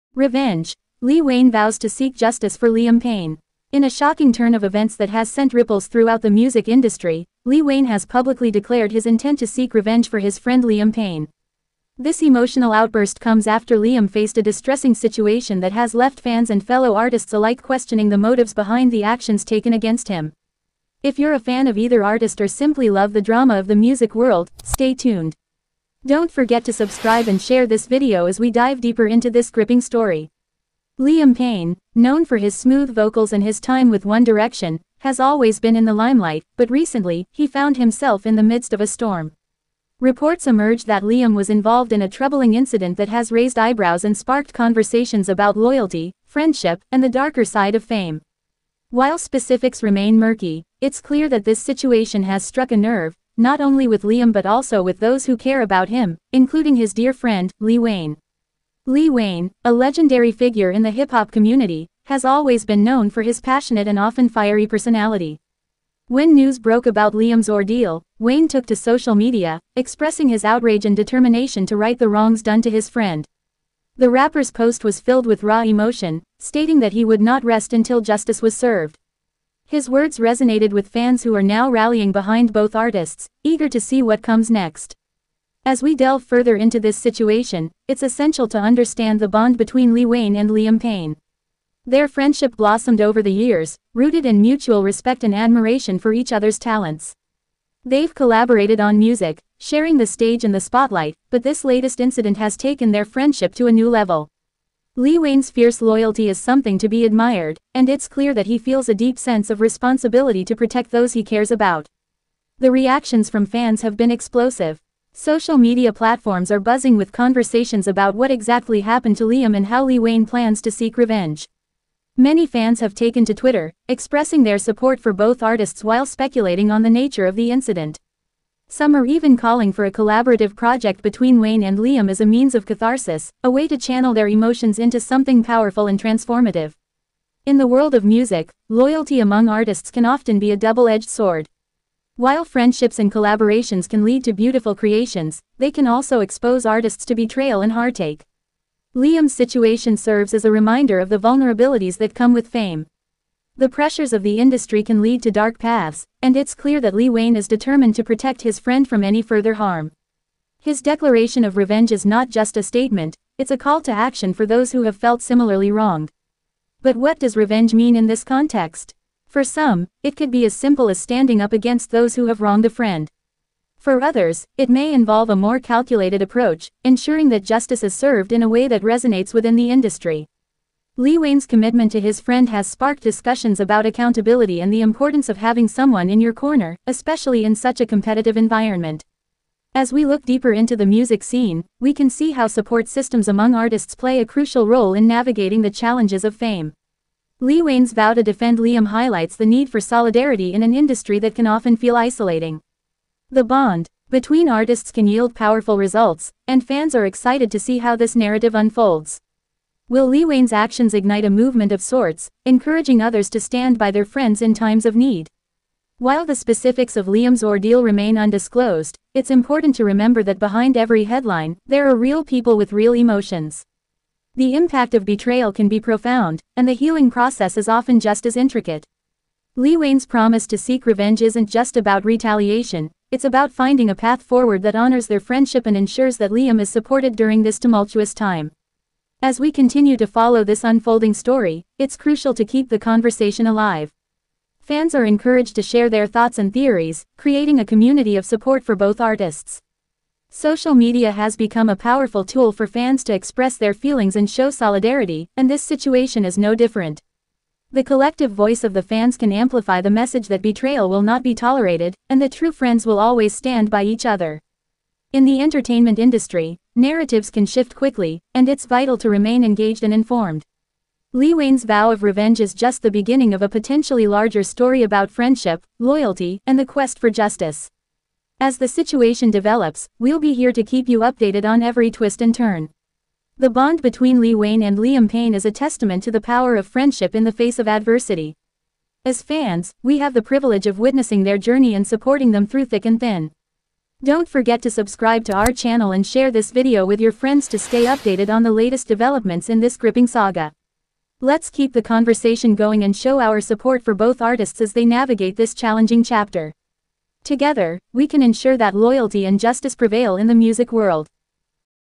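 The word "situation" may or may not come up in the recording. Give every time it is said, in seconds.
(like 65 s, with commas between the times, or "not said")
14 s, 51 s, 86 s, 149 s, 255 s, 278 s.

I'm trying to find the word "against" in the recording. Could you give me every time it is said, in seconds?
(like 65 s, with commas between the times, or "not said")
19 s, 171 s.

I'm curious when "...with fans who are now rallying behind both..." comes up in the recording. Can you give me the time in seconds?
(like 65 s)
80 s.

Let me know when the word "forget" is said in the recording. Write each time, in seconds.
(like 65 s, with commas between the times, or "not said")
26 s, 294 s.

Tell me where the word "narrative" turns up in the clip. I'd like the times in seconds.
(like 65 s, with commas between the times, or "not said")
208 s, 266 s.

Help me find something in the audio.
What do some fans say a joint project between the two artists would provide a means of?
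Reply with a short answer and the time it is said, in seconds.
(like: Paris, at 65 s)
catharsis, at 132 s.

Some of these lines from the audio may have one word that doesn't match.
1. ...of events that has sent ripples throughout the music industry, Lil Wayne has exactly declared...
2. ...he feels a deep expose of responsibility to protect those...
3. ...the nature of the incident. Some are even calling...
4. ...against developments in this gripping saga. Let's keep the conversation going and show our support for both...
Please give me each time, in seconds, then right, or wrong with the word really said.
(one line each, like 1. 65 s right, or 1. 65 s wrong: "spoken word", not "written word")
1. 4 s wrong: "publicly", not "exactly"
2. 108 s wrong: "sense", not "expose"
3. 126 s right
4. 298 s wrong: "latest", not "against".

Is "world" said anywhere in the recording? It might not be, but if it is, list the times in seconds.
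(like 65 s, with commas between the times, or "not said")
24 s, 137 s, 310 s.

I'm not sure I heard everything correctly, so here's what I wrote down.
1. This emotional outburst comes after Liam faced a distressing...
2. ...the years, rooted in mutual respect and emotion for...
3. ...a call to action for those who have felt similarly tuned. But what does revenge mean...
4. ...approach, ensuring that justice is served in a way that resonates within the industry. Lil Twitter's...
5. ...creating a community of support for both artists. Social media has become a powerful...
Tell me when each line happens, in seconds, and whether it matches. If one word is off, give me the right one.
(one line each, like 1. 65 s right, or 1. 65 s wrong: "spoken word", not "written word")
1. 11 s right
2. 93 s wrong: "admiration", not "emotion"
3. 163 s wrong: "wronged", not "tuned"
4. 176 s wrong: "Wayne", not "Twitter"
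5. 247 s right.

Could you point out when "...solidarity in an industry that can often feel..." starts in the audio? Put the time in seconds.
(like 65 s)
199 s.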